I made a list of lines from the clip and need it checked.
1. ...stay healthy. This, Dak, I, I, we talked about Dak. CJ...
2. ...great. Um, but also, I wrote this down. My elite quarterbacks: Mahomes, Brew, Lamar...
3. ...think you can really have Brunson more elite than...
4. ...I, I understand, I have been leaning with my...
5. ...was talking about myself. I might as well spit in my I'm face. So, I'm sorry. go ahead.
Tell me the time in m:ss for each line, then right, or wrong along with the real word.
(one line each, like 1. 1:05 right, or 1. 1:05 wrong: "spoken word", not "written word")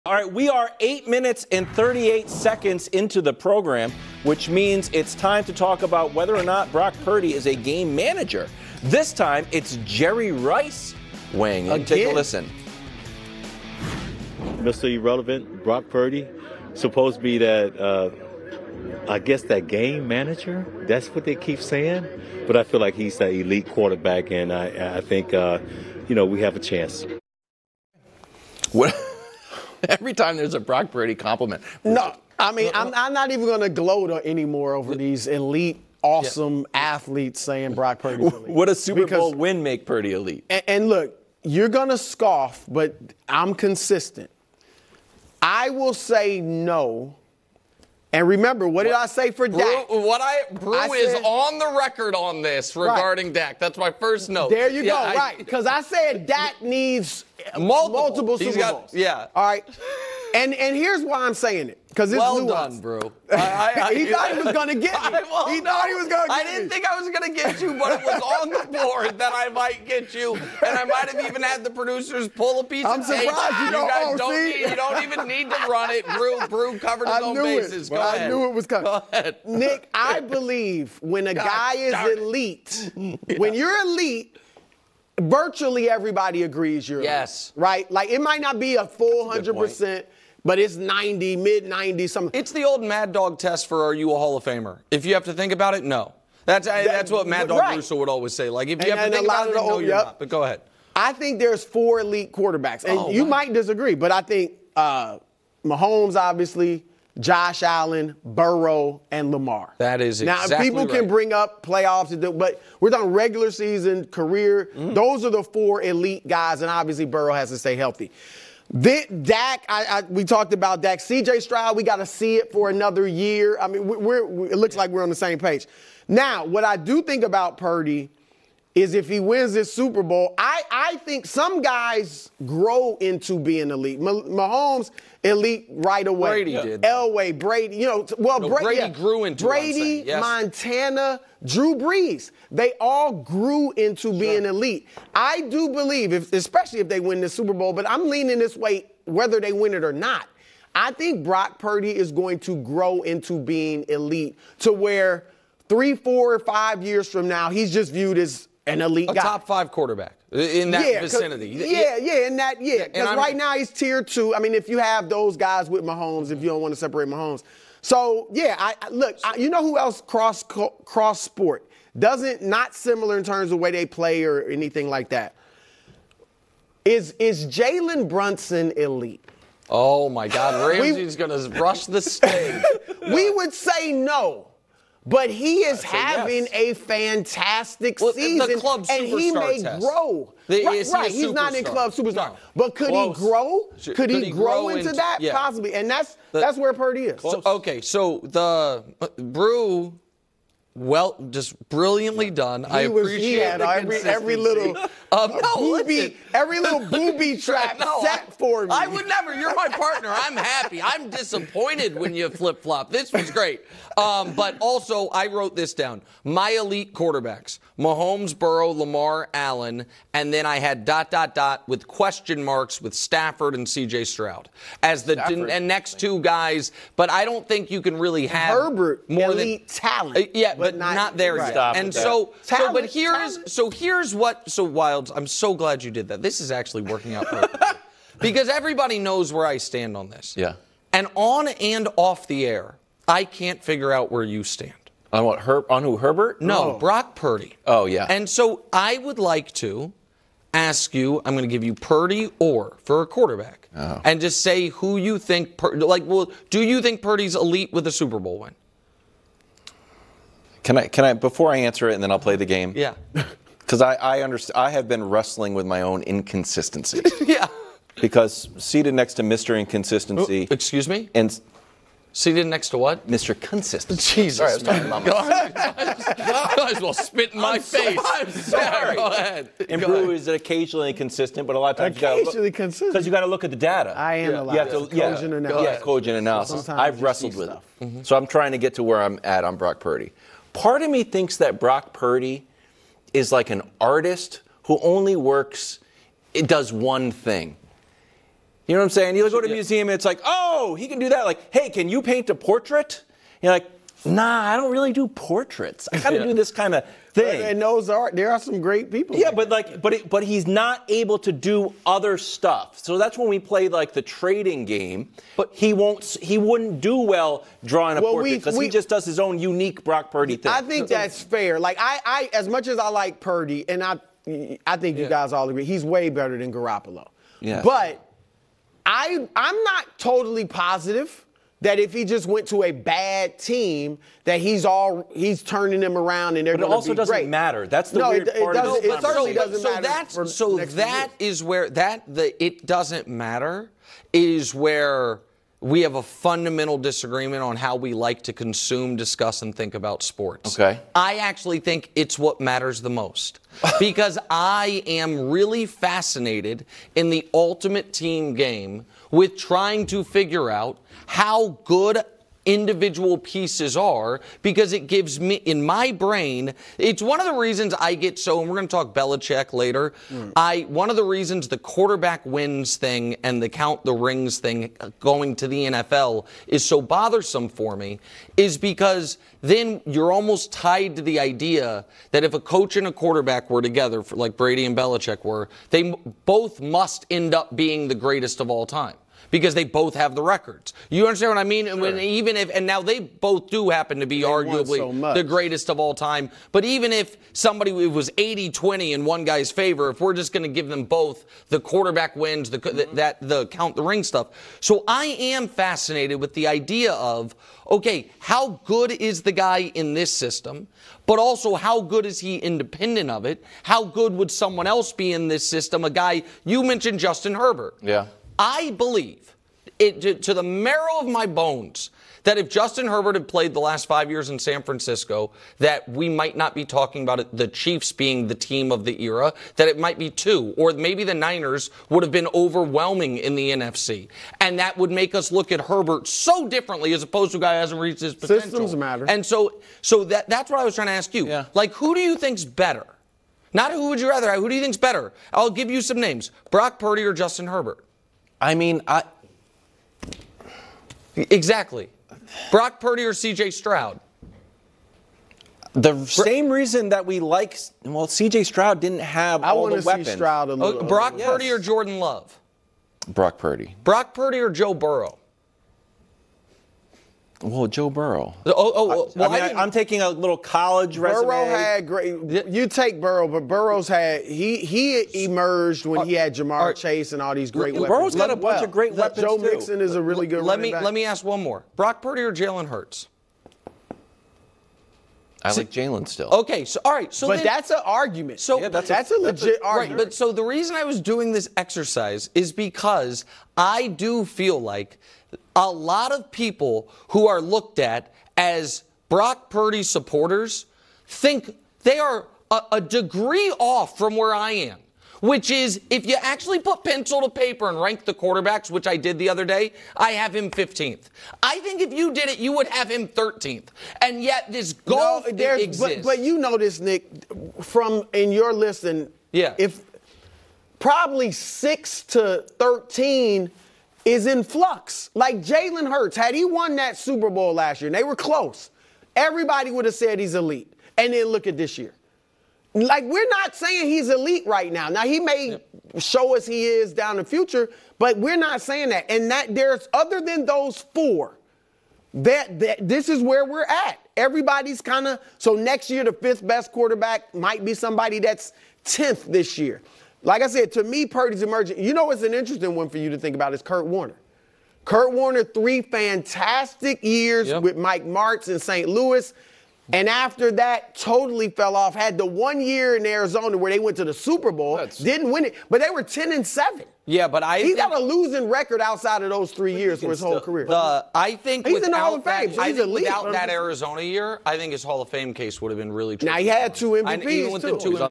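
1. 1:57 right
2. 3:33 wrong: "Burrow", not "Brew"
3. 3:47 wrong: "Herbert", not "Brunson"
4. 4:23 wrong: "wrestling", not "leaning"
5. 4:34 right.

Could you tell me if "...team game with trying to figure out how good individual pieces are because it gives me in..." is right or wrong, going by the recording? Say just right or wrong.
right.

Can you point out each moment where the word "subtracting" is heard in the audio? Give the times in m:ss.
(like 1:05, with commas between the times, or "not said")
not said.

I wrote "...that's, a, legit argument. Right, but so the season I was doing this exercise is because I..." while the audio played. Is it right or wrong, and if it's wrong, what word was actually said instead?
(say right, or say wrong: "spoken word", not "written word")
wrong: "reason", not "season".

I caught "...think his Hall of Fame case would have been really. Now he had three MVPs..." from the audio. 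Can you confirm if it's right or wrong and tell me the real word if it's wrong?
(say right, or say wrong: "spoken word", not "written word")
wrong: "two", not "three".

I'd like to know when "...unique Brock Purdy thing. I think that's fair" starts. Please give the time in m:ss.
5:19.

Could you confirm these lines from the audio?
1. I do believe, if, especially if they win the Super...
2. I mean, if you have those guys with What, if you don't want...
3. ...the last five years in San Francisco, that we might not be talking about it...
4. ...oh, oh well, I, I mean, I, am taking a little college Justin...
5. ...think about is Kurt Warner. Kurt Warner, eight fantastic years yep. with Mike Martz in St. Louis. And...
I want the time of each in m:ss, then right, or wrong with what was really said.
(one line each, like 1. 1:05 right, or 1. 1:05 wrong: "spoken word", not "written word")
1. 2:25 right
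2. 2:44 wrong: "Mahomes", not "What"
3. 7:03 right
4. 7:48 wrong: "Burrow", not "Justin"
5. 9:13 wrong: "three", not "eight".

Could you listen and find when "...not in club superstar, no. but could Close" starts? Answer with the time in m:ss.
3:11.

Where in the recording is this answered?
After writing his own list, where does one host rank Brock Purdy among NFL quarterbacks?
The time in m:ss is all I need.
8:30.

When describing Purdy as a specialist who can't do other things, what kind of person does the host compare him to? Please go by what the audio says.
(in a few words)
An artist.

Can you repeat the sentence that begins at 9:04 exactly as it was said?
Everybody's kind of so next year the fifth best quarterback might be somebody that's tenth this year.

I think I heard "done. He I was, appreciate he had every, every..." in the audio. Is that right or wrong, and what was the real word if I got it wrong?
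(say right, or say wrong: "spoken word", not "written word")
right.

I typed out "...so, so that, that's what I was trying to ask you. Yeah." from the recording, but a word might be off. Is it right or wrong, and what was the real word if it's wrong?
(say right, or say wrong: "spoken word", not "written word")
right.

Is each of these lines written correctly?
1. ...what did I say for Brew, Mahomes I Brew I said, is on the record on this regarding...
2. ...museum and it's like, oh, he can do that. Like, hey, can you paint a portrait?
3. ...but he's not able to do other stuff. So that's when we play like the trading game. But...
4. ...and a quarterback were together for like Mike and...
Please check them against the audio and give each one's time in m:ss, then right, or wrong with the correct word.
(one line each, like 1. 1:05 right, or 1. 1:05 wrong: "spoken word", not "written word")
1. 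0:48 wrong: "What", not "Mahomes"
2. 4:59 right
3. 5:10 right
4. 6:22 wrong: "Brady", not "Mike".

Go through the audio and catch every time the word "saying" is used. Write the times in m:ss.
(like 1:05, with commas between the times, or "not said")
0:21, 0:37, 1:01, 4:58, 8:53, 8:58.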